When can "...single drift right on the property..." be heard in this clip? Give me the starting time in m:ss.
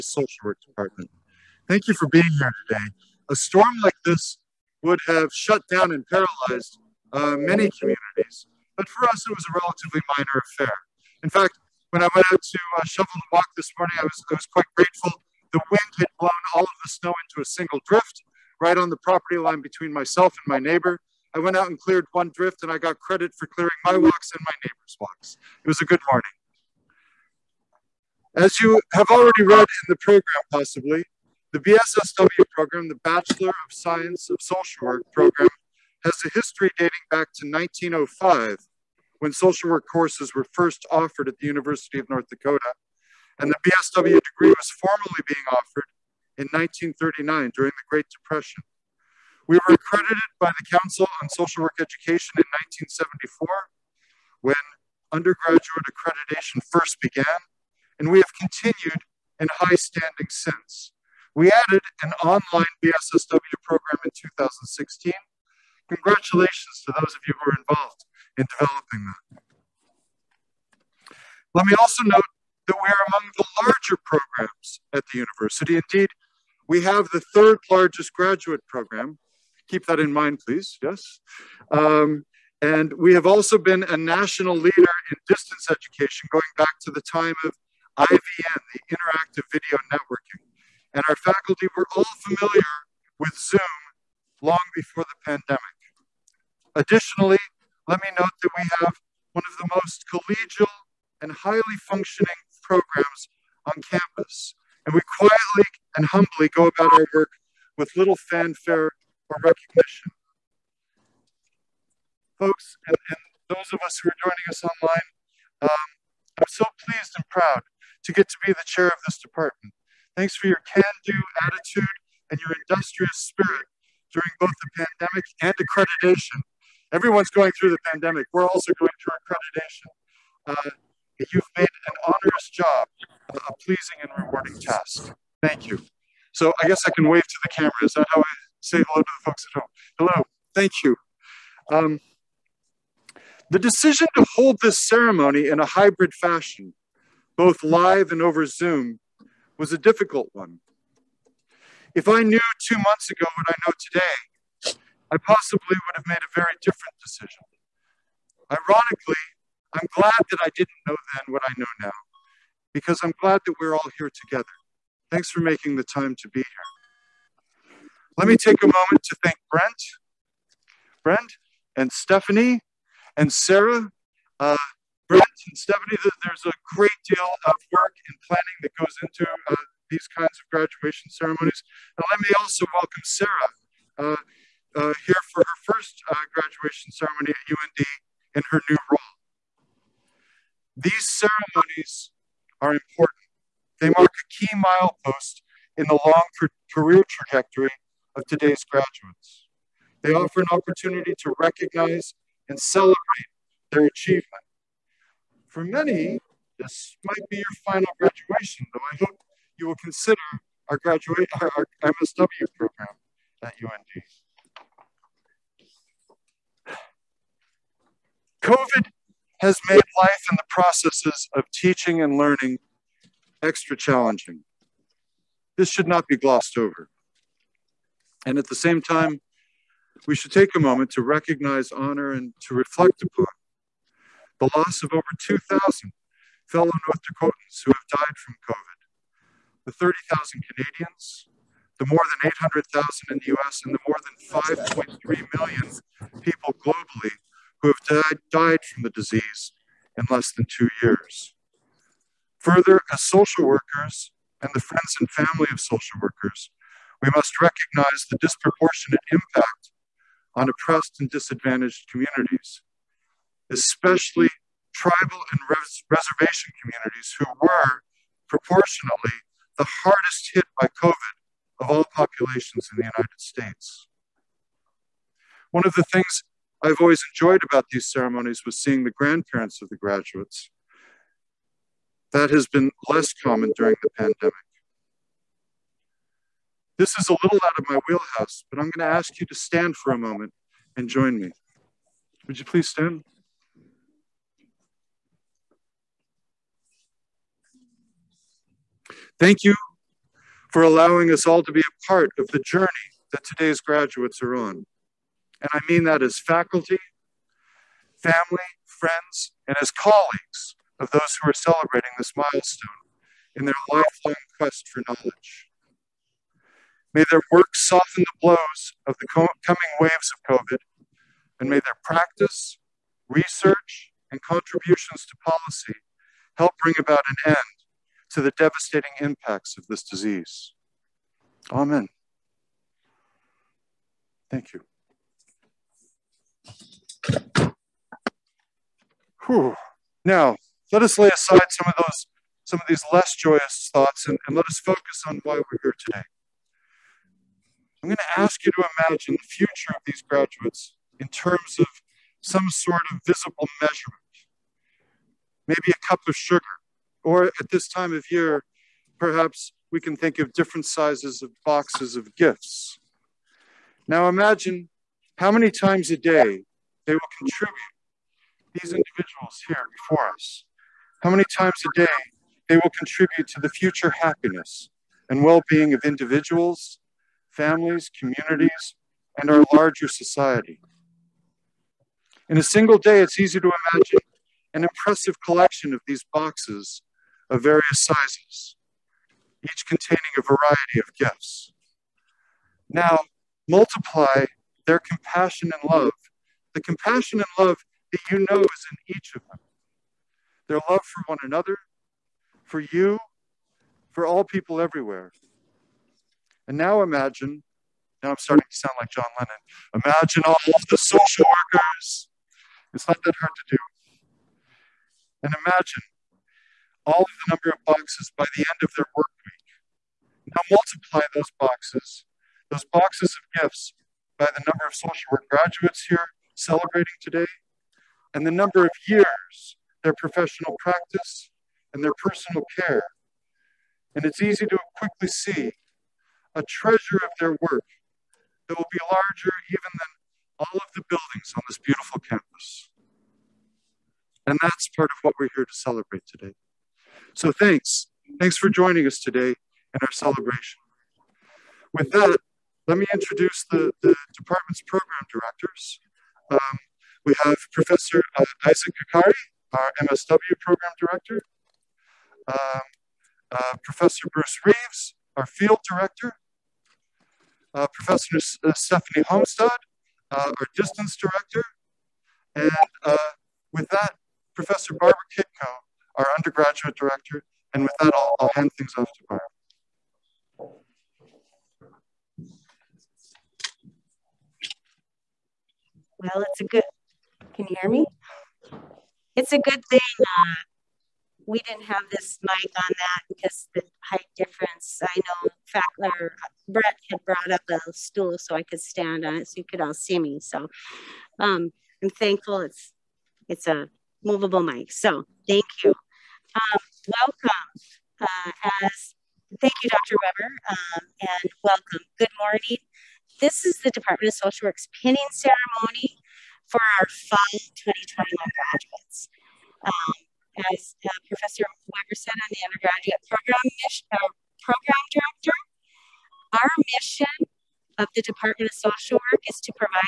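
0:17.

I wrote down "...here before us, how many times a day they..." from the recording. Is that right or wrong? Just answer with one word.
right.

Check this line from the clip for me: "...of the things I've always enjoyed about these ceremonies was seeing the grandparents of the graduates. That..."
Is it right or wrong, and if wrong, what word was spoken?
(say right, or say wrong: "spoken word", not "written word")
right.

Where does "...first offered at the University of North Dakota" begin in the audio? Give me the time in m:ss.
0:40.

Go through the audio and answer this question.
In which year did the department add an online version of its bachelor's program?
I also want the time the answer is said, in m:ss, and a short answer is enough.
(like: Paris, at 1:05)
2016, at 1:04.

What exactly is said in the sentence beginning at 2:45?
Thanks for making the time to be here.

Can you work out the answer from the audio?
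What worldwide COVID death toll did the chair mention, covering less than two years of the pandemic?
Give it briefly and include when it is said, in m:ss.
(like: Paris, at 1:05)
5.3 million, at 4:04.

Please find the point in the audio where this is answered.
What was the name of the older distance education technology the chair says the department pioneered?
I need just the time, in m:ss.
1:28.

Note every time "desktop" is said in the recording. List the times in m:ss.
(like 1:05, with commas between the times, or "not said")
not said.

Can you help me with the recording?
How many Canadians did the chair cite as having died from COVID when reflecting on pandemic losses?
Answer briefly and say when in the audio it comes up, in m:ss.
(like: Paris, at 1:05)
30,000, at 3:59.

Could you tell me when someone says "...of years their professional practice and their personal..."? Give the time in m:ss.
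7:08.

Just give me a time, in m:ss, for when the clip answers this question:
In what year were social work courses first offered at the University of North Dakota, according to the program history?
0:37.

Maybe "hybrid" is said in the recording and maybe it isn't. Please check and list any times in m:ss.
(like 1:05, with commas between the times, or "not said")
2:25.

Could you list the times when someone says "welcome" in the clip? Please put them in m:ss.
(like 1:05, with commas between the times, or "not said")
3:02, 8:26, 8:31.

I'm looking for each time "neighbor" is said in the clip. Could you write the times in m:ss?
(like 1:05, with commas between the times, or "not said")
0:20, 0:24.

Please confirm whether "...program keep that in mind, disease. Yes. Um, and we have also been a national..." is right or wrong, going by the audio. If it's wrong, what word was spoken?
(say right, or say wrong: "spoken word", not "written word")
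wrong: "please", not "disease".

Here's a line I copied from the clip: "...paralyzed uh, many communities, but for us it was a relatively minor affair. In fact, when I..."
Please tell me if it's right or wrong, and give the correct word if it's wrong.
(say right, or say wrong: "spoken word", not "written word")
right.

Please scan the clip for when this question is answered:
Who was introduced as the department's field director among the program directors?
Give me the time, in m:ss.
7:44.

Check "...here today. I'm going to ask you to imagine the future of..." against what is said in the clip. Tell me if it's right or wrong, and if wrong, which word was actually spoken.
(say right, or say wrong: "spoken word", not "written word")
right.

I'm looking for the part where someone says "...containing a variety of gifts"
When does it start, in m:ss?
6:29.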